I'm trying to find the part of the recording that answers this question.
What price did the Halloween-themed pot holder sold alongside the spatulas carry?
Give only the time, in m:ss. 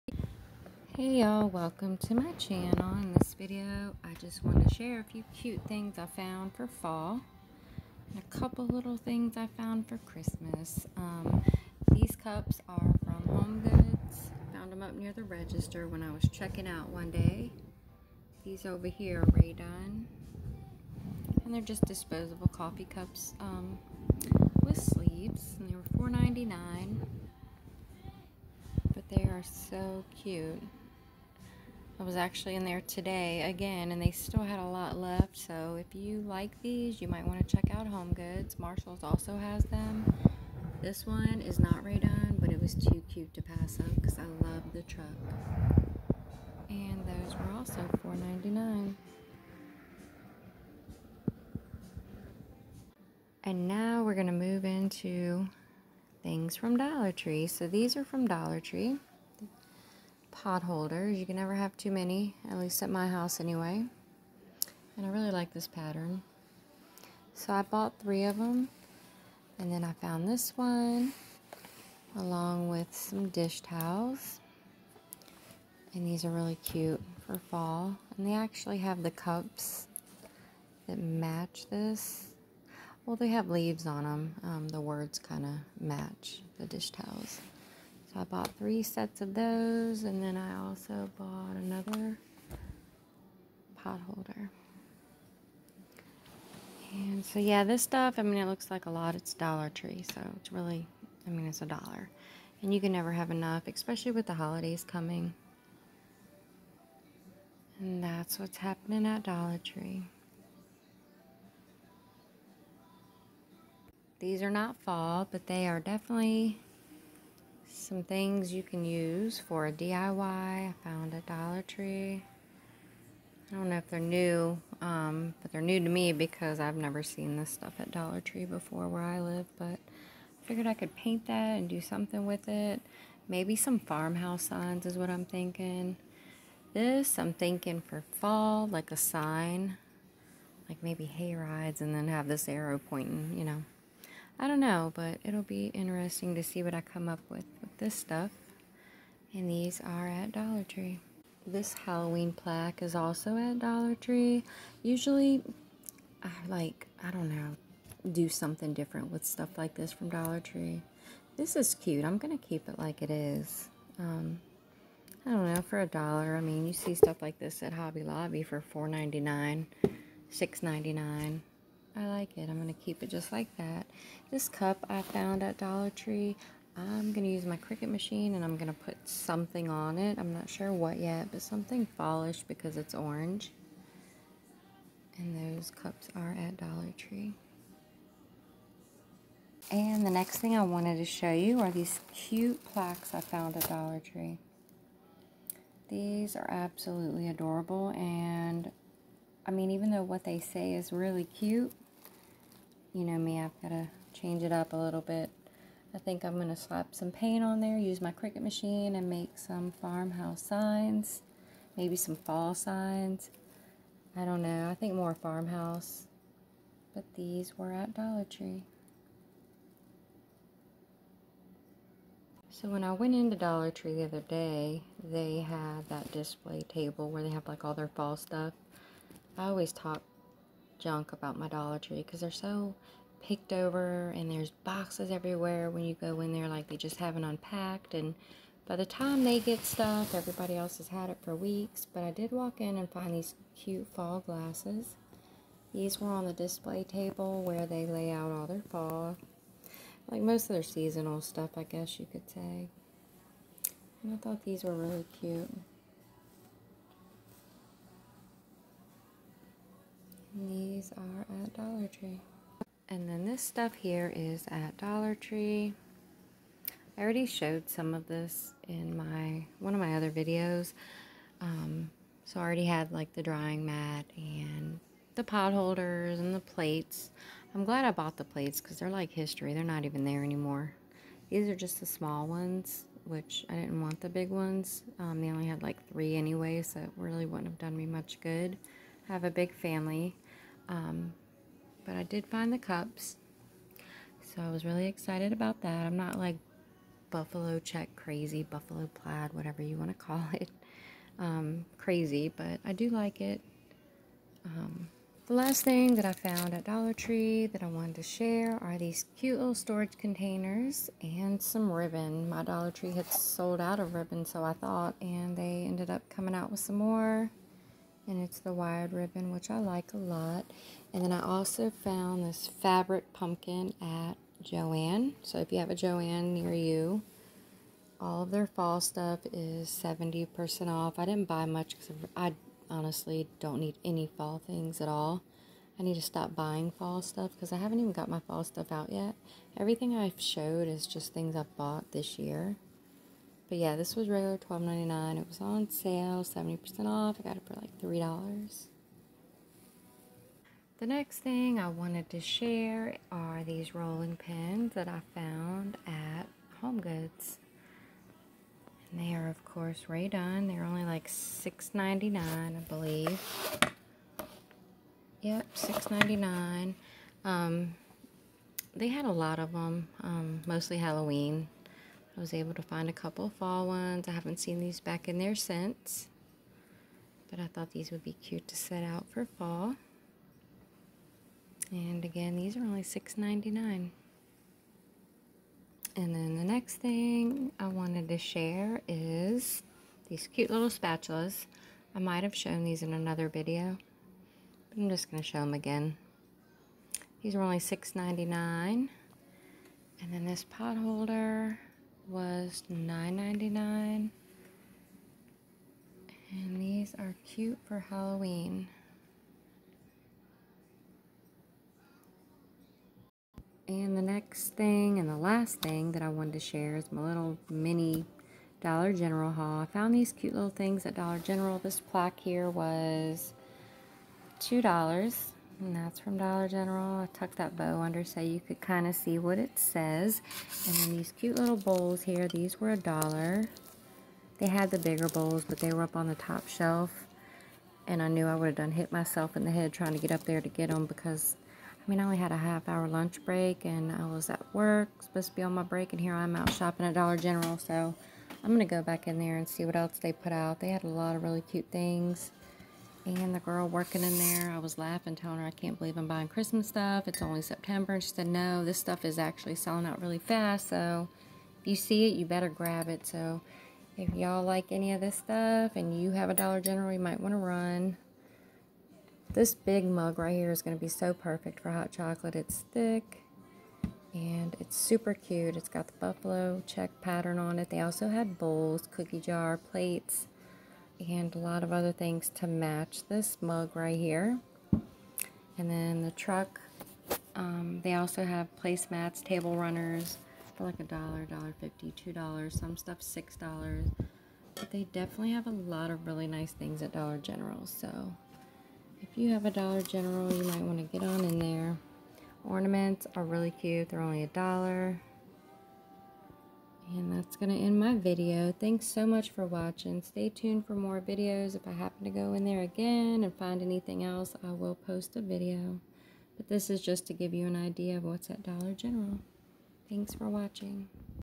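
6:42.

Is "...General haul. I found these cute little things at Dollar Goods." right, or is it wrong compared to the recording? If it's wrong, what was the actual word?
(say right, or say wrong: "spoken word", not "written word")
wrong: "General", not "Goods".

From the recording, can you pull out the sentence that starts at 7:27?
So I'm going to go back in there and see what else they put out.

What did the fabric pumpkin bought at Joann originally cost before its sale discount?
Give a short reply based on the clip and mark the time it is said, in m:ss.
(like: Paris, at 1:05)
$12.99, at 5:44.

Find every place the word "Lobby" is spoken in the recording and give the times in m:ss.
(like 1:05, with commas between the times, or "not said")
2:48.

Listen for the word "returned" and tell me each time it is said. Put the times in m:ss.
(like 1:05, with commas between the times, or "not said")
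not said.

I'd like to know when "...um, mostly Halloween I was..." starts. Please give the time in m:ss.
6:10.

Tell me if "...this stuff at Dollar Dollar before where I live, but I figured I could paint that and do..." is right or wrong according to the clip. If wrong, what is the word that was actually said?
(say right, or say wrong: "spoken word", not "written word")
wrong: "Tree", not "Dollar".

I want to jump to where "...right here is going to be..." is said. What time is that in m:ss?
7:50.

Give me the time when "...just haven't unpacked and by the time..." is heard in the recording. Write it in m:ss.
3:56.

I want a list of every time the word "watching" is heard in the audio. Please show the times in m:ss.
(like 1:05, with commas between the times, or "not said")
8:29, 8:40.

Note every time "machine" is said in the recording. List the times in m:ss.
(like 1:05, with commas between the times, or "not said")
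2:57, 3:28.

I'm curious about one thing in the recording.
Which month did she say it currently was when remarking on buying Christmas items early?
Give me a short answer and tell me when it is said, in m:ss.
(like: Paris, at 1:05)
September, at 7:37.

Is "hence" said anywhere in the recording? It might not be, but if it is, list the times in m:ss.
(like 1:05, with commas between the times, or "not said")
not said.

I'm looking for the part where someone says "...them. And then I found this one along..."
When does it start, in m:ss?
1:08.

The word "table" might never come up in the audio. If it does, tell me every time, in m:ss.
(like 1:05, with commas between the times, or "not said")
3:46, 4:06, 8:09.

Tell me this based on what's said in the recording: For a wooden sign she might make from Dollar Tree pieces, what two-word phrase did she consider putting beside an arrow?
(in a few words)
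hay rides.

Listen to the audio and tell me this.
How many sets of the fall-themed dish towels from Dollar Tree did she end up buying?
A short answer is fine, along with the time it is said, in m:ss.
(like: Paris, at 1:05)
3, at 1:28.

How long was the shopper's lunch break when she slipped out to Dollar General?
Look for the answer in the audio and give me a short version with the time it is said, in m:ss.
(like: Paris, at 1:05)
half hour, at 7:22.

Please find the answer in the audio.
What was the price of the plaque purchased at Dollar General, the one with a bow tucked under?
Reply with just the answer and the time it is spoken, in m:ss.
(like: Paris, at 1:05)
$2, at 7:04.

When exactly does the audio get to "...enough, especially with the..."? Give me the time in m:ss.
1:43.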